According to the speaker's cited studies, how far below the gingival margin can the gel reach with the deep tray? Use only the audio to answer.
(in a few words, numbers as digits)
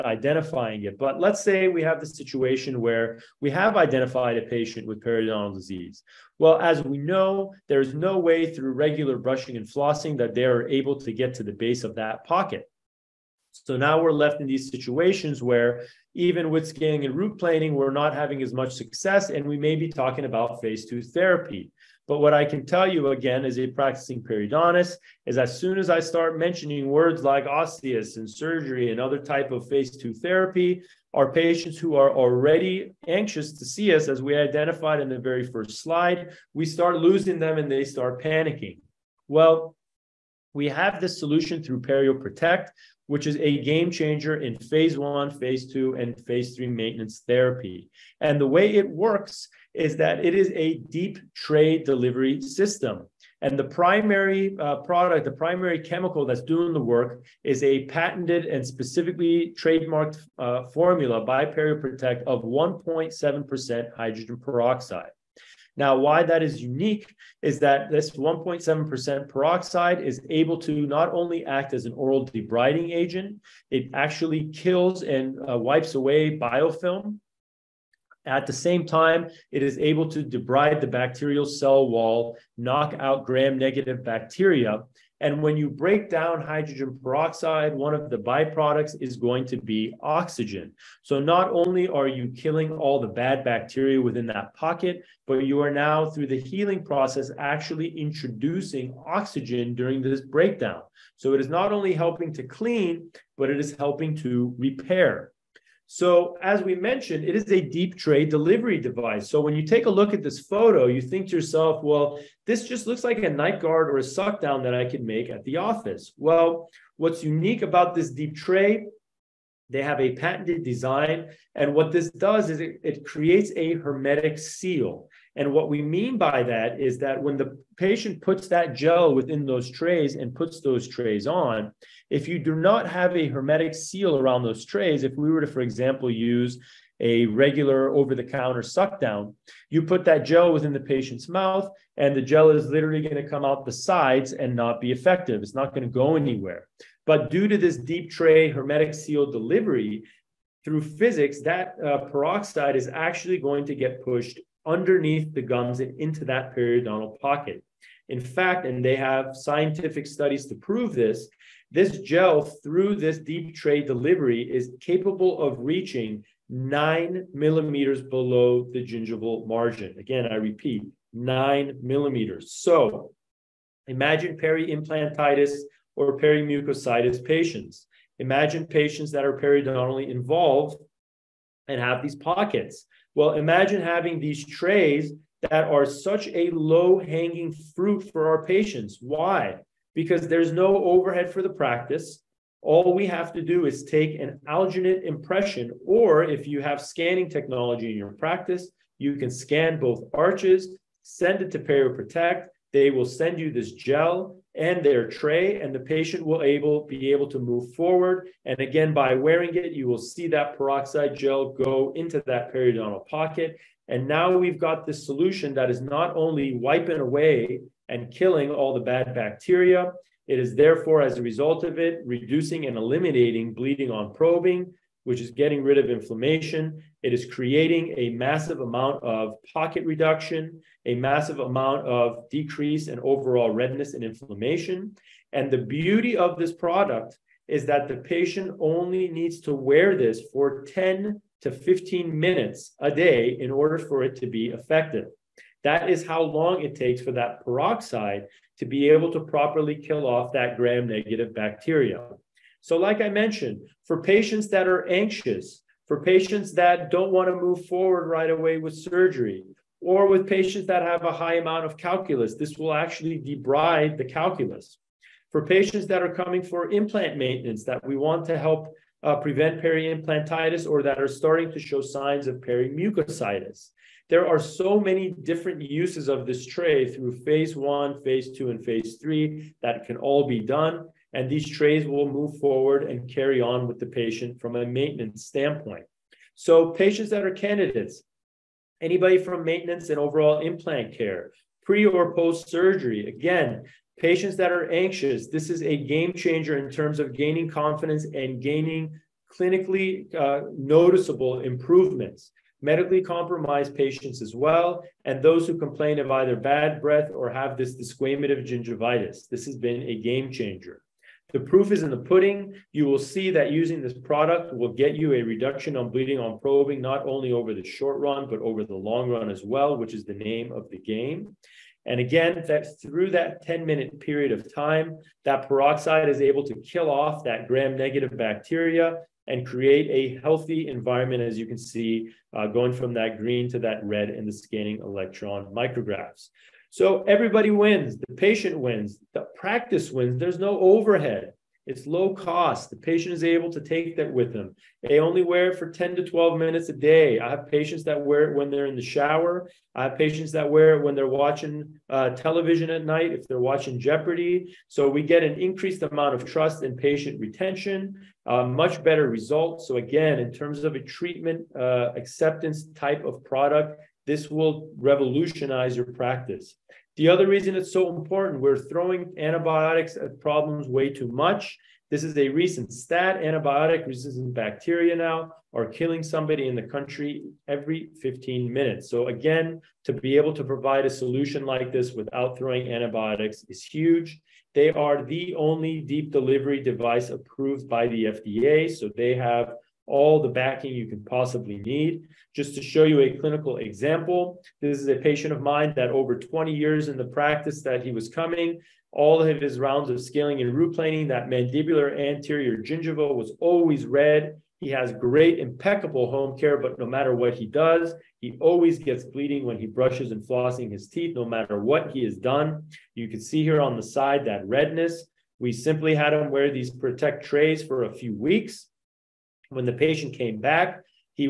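9 millimeters.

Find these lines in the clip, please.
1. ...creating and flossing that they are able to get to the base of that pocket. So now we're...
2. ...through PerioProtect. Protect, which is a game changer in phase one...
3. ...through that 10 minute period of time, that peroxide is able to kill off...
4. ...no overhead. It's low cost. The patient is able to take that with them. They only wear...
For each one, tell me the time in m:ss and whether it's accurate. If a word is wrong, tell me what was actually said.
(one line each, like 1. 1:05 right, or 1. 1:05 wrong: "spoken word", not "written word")
1. 0:09 wrong: "brushing", not "creating"
2. 0:41 right
3. 5:22 right
4. 5:40 right.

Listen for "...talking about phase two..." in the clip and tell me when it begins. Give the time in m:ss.
0:19.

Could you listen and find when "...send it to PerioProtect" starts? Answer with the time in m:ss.
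3:21.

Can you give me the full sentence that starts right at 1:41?
So it is not only helping to clean, but it is helping to repair.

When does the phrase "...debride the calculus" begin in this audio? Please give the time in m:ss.
4:23.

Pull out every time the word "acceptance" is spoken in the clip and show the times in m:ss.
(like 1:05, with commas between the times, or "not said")
6:01.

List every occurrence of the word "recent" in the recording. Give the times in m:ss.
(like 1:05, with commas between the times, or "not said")
6:12.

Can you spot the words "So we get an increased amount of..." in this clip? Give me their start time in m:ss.
5:54.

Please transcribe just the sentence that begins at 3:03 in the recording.
Well, imagine having these trays that are such a low hanging fruit for our patients.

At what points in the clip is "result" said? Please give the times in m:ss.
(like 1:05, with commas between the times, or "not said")
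3:41, 5:59.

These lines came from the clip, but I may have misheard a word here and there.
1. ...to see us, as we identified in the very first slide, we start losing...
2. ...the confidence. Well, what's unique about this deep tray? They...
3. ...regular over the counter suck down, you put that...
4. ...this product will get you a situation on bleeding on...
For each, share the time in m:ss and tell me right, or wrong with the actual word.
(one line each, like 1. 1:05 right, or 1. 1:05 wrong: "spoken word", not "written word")
1. 0:33 right
2. 1:55 wrong: "office", not "confidence"
3. 2:17 right
4. 5:13 wrong: "reduction", not "situation".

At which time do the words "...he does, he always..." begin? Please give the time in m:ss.
6:47.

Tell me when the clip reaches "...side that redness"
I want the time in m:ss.
6:53.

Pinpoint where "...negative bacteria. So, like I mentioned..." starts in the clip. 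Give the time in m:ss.
4:10.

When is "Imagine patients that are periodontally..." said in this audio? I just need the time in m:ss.
2:58.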